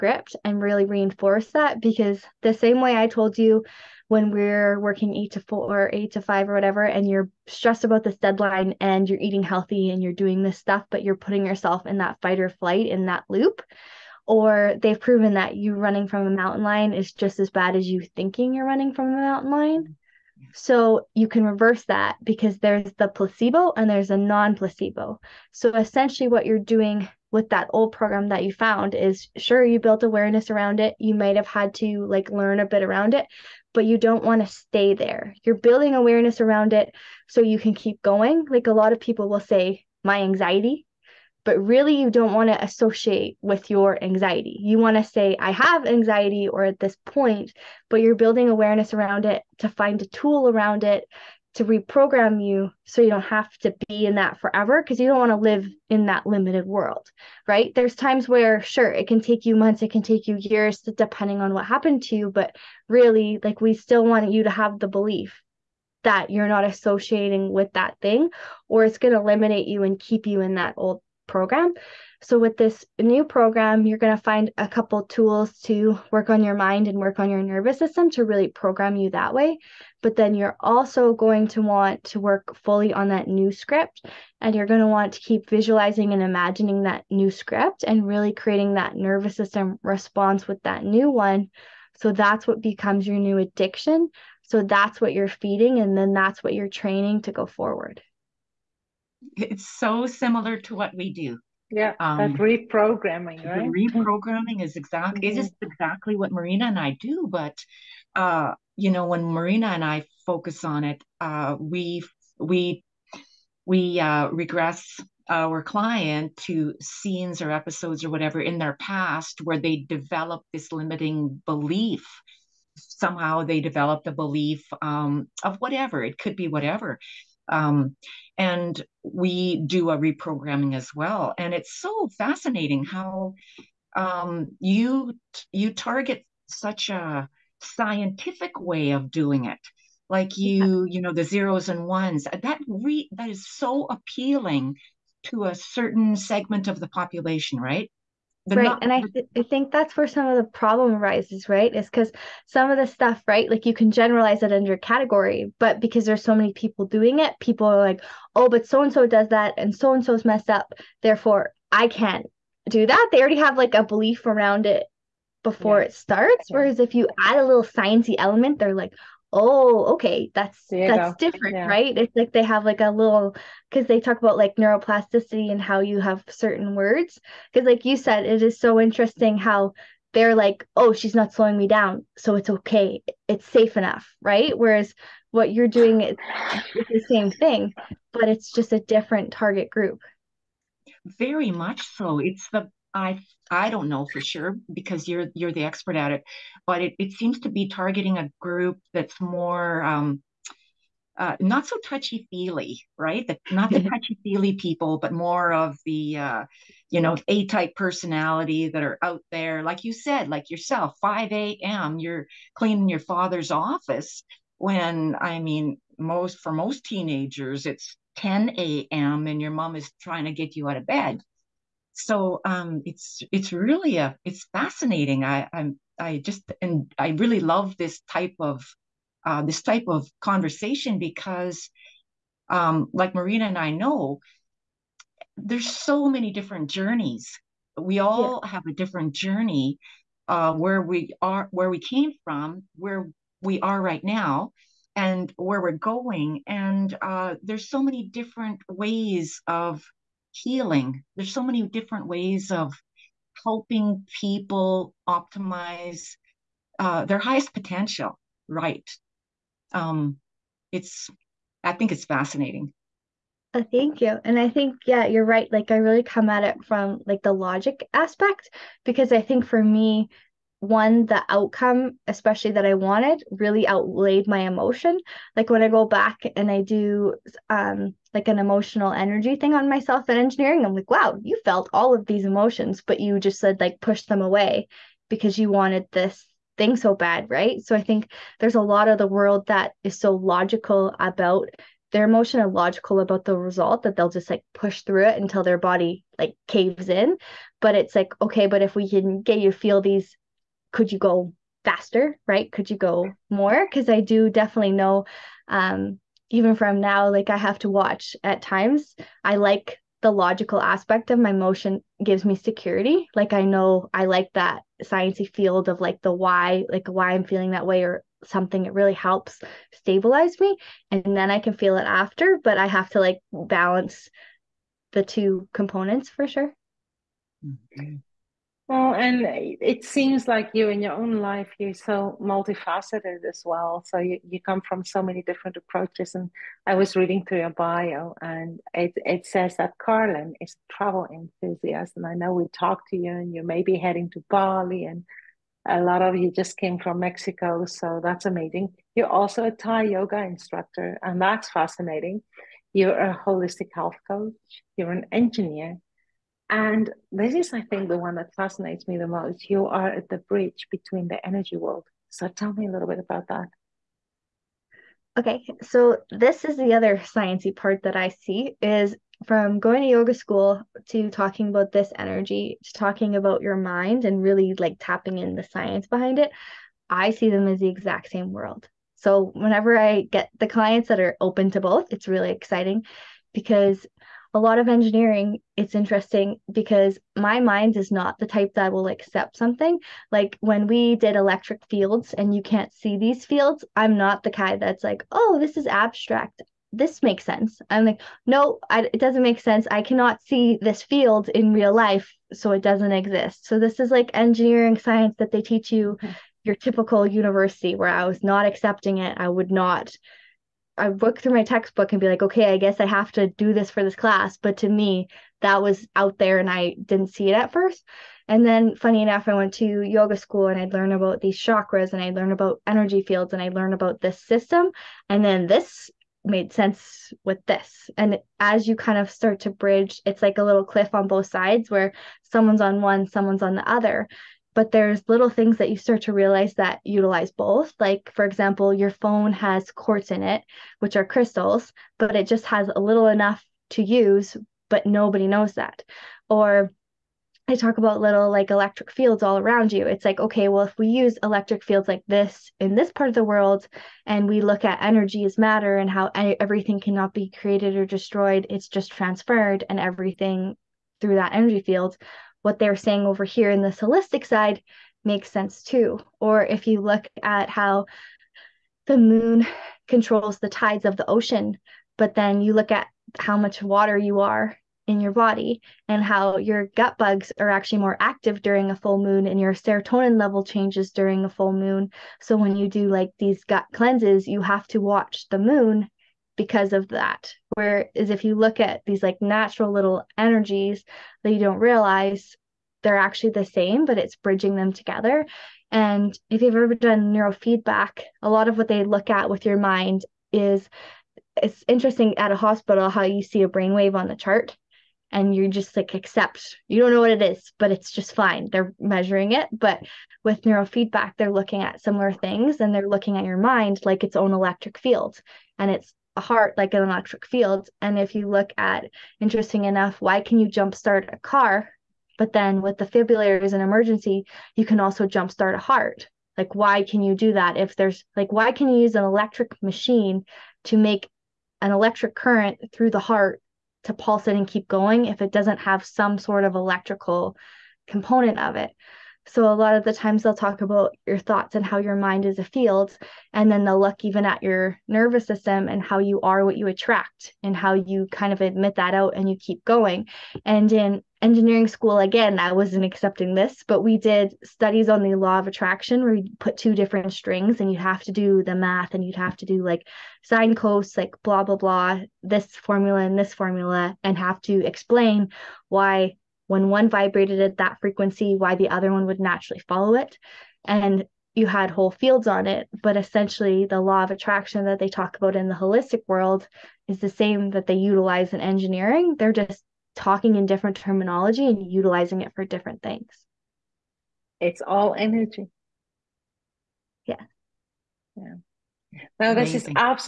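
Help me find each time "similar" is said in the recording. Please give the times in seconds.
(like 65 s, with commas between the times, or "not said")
100 s, 511 s.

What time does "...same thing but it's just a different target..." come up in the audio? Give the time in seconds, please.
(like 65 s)
187 s.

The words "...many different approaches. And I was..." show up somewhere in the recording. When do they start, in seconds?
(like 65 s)
335 s.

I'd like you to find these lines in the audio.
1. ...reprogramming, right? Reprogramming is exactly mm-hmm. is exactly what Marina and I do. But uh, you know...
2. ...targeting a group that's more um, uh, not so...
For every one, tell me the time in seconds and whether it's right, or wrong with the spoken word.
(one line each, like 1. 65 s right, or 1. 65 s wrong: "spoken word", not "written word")
1. 102 s right
2. 197 s right.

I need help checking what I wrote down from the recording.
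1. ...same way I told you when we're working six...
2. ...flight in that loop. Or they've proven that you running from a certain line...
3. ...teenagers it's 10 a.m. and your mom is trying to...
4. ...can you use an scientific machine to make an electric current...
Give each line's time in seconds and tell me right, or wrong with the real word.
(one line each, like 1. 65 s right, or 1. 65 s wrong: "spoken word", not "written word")
1. 2 s wrong: "eight", not "six"
2. 12 s wrong: "mountain", not "certain"
3. 216 s right
4. 528 s wrong: "electric", not "scientific".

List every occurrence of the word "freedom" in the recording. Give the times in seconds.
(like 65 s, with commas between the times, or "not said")
not said.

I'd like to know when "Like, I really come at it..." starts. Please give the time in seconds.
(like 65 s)
265 s.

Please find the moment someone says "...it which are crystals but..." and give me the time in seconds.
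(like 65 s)
440 s.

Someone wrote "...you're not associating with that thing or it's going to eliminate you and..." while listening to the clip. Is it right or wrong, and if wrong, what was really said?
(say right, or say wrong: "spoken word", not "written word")
right.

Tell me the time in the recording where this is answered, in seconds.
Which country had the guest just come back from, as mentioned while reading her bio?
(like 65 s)
346 s.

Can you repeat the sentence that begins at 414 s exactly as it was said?
But to me, that was out there and I didn't see it at first.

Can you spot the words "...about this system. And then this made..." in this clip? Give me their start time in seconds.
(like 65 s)
423 s.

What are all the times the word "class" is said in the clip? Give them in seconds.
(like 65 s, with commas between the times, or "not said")
413 s.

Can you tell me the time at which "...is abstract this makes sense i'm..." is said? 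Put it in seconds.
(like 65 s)
395 s.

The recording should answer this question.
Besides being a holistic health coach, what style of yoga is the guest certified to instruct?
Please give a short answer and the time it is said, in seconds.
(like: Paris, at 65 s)
Thai yoga, at 349 s.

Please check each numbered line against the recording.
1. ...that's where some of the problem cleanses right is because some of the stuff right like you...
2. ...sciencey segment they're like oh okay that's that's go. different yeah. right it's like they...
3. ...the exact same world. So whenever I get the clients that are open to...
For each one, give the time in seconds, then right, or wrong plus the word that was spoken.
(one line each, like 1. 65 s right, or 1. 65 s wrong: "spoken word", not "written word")
1. 149 s wrong: "arises", not "cleanses"
2. 167 s wrong: "element", not "segment"
3. 377 s right.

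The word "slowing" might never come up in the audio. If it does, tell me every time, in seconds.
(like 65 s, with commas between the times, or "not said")
181 s.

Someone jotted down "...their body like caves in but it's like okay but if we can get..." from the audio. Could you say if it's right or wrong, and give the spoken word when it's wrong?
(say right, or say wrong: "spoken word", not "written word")
right.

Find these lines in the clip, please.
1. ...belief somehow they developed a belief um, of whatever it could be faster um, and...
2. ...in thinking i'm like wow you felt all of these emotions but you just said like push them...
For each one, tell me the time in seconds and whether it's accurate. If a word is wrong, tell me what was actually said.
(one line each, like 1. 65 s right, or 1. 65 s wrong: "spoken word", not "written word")
1. 121 s wrong: "whatever", not "faster"
2. 280 s wrong: "engineering", not "thinking".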